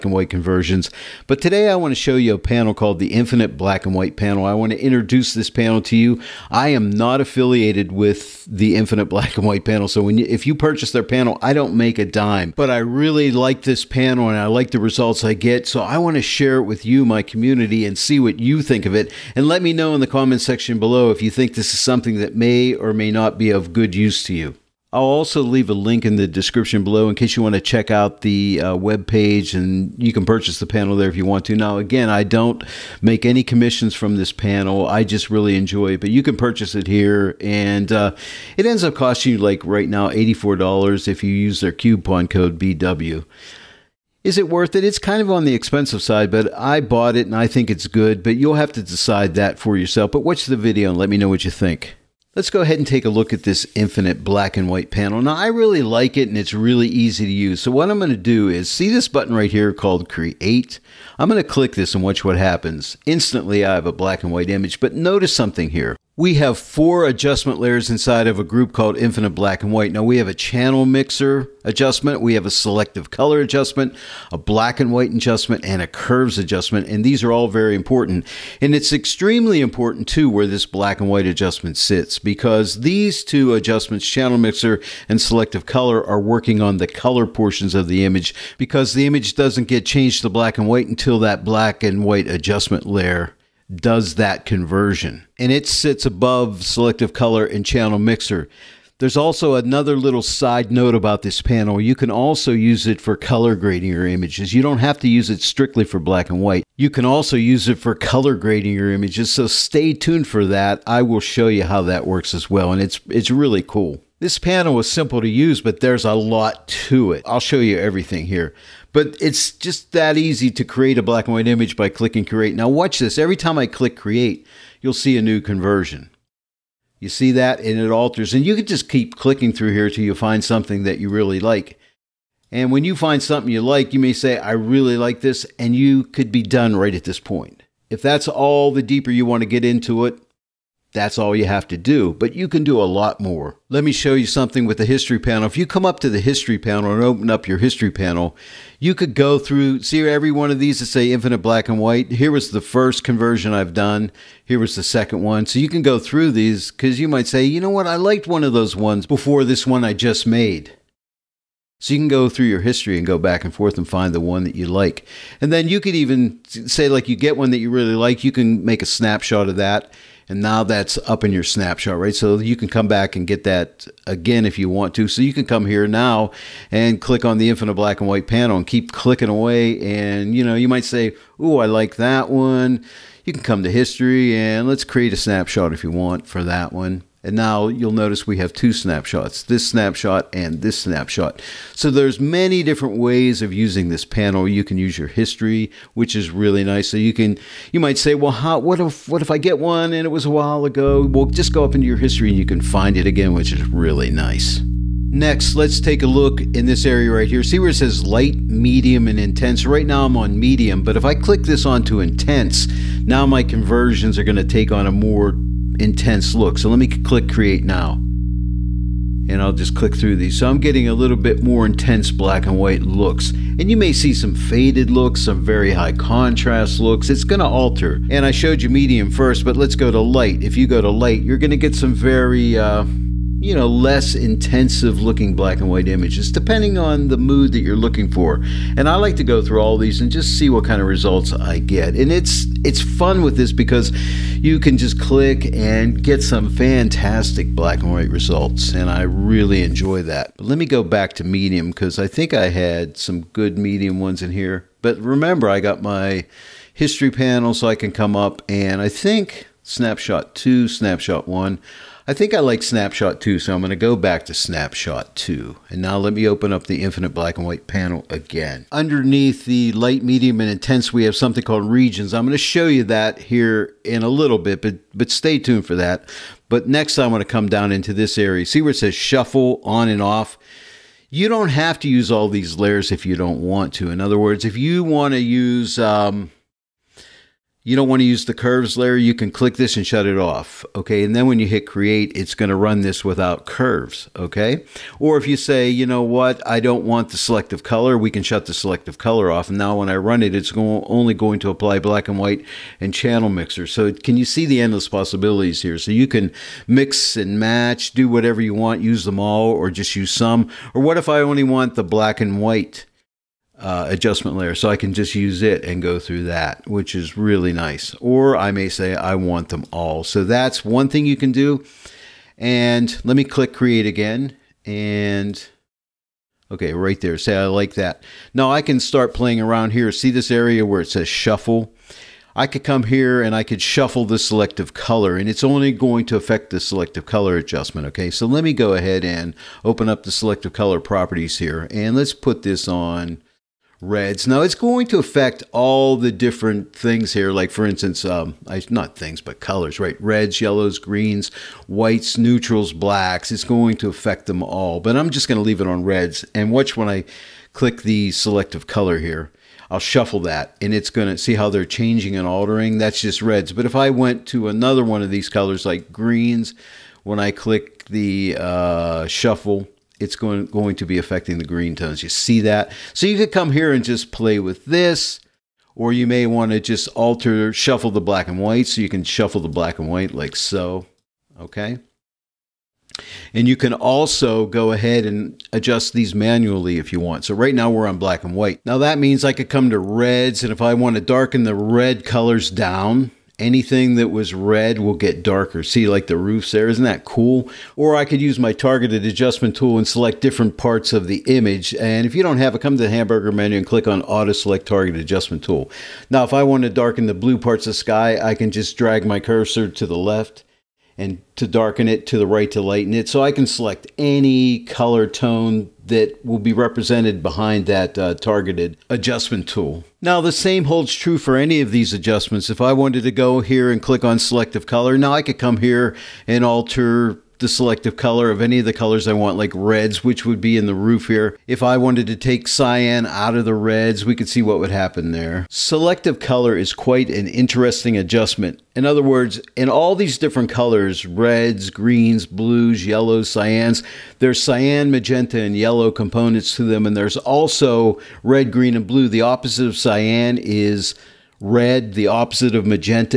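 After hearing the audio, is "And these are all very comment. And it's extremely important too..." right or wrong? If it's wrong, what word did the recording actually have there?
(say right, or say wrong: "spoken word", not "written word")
wrong: "important", not "comment".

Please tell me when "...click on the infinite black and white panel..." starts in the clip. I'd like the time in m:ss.
2:57.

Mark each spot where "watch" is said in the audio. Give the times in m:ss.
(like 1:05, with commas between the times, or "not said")
0:50, 1:02, 2:02, 5:56.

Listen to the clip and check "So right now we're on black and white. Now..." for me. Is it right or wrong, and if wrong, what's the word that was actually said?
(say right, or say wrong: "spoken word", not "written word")
right.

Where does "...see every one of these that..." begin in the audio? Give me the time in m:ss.
2:29.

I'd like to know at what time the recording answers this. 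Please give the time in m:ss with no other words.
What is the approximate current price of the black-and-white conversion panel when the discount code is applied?
0:40.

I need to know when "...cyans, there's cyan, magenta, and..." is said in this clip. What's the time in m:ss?
7:23.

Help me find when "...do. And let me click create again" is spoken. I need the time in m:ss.
5:21.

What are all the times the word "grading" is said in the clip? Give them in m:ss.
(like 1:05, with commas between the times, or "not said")
1:43, 1:48.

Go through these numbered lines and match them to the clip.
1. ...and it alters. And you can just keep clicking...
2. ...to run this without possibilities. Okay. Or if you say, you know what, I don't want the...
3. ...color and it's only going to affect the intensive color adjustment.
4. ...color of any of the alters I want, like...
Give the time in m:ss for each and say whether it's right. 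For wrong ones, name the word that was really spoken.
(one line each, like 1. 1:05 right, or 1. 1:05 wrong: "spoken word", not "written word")
1. 2:07 right
2. 4:52 wrong: "curves", not "possibilities"
3. 5:34 wrong: "selective", not "intensive"
4. 7:07 wrong: "colors", not "alters".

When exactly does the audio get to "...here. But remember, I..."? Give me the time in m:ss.
4:14.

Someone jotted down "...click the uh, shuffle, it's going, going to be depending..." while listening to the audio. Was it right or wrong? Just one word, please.
wrong.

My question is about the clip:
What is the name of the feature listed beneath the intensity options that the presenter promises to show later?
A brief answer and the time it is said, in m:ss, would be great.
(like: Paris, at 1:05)
regions, at 4:31.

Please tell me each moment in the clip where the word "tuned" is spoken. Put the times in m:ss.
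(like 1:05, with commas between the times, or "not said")
1:49, 4:35.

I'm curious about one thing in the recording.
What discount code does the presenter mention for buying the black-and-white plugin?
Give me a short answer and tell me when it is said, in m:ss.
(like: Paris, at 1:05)
BW, at 0:42.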